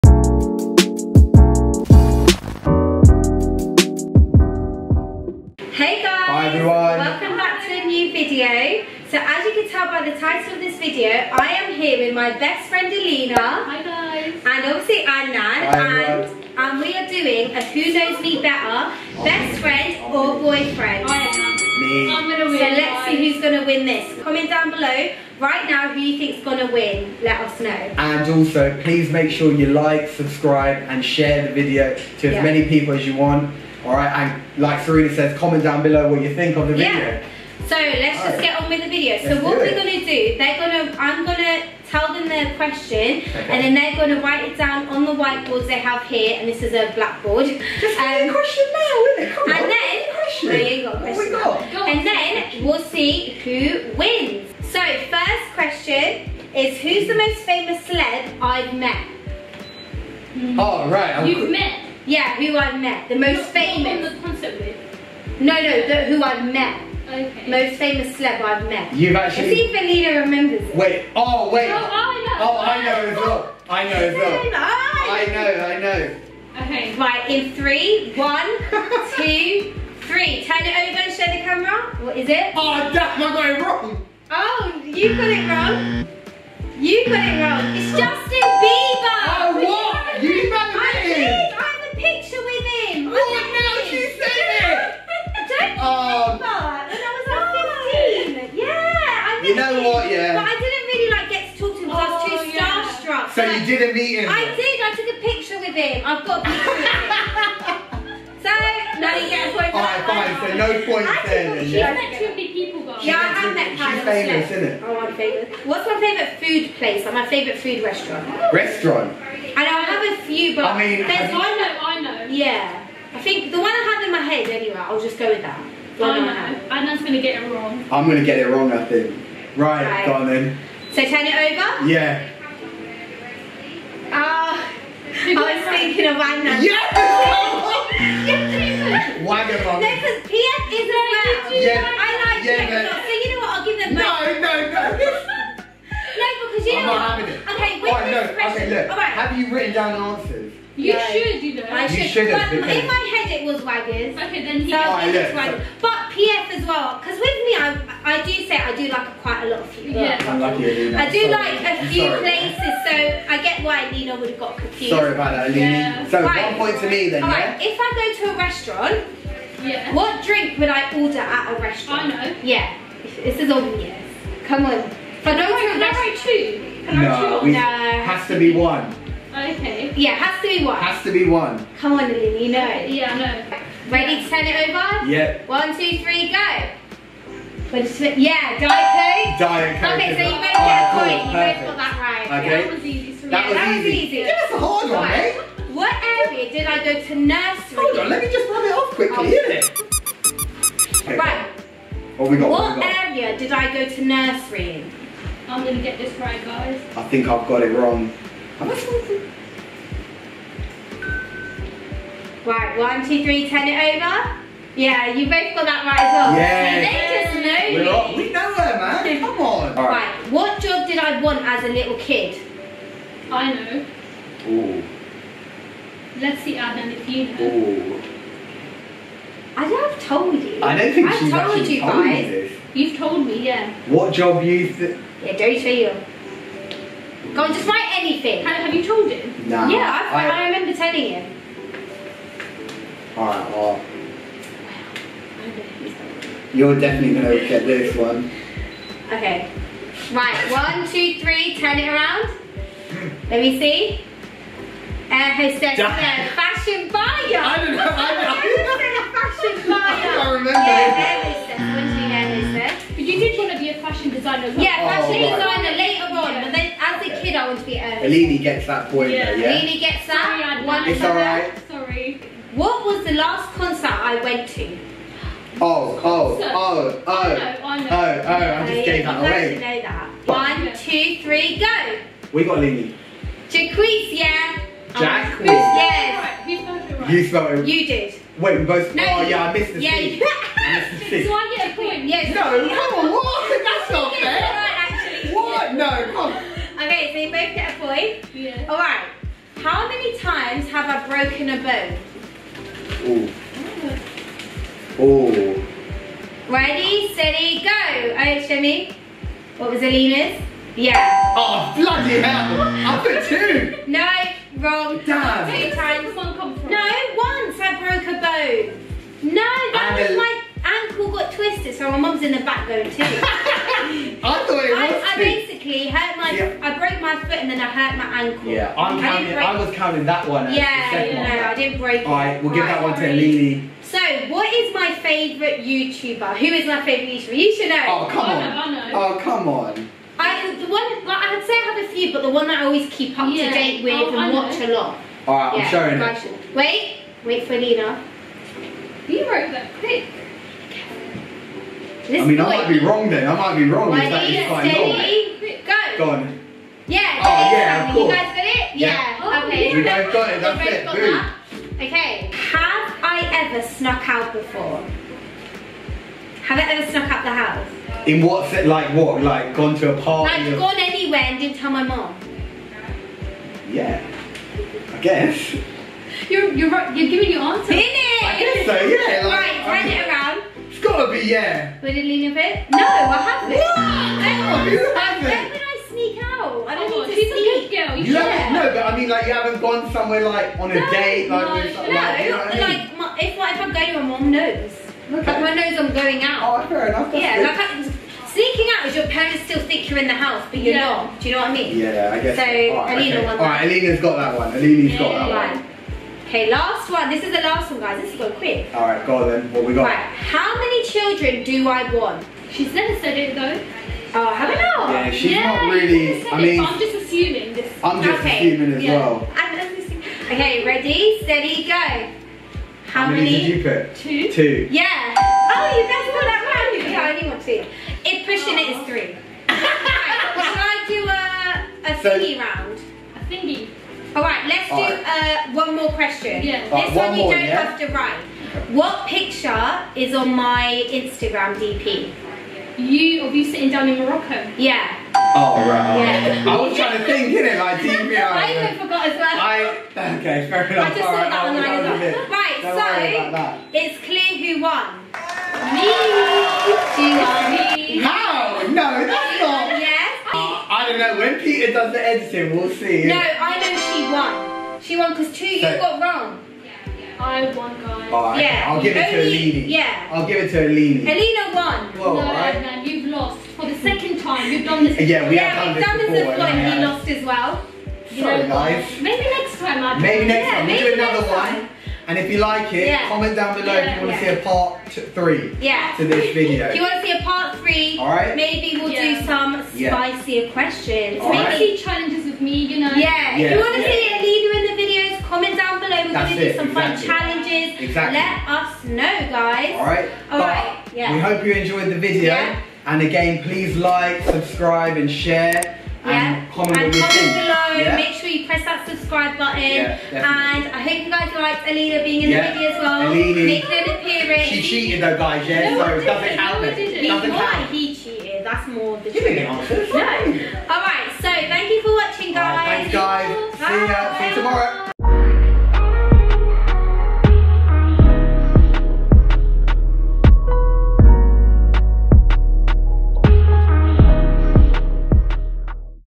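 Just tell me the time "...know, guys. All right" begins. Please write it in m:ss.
8:18.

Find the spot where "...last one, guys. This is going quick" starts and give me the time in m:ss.
6:47.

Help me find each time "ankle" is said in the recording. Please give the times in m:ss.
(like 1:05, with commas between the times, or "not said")
5:20, 5:28.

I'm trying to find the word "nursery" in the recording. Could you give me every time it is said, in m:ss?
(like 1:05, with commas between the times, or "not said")
3:17, 3:24.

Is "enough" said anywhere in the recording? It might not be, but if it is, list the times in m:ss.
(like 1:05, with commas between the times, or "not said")
6:36, 7:30.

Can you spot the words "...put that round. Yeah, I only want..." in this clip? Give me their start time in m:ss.
7:06.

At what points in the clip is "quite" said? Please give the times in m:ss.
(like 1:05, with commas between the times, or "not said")
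2:39, 5:54.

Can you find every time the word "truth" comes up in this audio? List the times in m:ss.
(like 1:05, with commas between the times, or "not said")
8:39.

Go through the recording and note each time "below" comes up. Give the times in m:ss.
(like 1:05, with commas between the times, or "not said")
0:24, 0:35, 8:03, 8:15, 8:27.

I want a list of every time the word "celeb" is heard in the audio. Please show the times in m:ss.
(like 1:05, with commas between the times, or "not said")
0:57, 1:08.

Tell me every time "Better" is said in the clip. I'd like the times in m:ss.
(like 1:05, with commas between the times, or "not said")
0:18.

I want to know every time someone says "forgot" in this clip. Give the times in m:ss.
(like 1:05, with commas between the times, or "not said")
7:28.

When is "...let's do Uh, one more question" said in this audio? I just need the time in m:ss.
7:14.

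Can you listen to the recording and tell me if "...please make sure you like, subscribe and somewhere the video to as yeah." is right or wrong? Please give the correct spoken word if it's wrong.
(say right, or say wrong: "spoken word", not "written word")
wrong: "share", not "somewhere".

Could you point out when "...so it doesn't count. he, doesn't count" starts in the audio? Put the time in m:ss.
8:35.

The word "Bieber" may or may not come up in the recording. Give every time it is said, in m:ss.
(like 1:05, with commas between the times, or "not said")
1:28.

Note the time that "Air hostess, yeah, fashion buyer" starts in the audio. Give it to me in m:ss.
4:15.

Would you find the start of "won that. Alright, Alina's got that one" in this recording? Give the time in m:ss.
6:43.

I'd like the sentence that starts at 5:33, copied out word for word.
So, what is my favourite YouTuber?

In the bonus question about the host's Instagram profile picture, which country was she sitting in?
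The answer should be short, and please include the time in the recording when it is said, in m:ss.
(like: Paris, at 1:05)
Morocco, at 7:23.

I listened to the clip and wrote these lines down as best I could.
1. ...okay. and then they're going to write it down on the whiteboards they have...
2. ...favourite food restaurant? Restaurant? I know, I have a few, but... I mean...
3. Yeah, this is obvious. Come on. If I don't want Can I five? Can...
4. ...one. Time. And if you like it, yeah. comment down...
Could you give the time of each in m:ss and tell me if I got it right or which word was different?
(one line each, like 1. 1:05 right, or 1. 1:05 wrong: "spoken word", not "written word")
1. 0:43 right
2. 1:57 right
3. 2:52 wrong: "two", not "five"
4. 8:01 right.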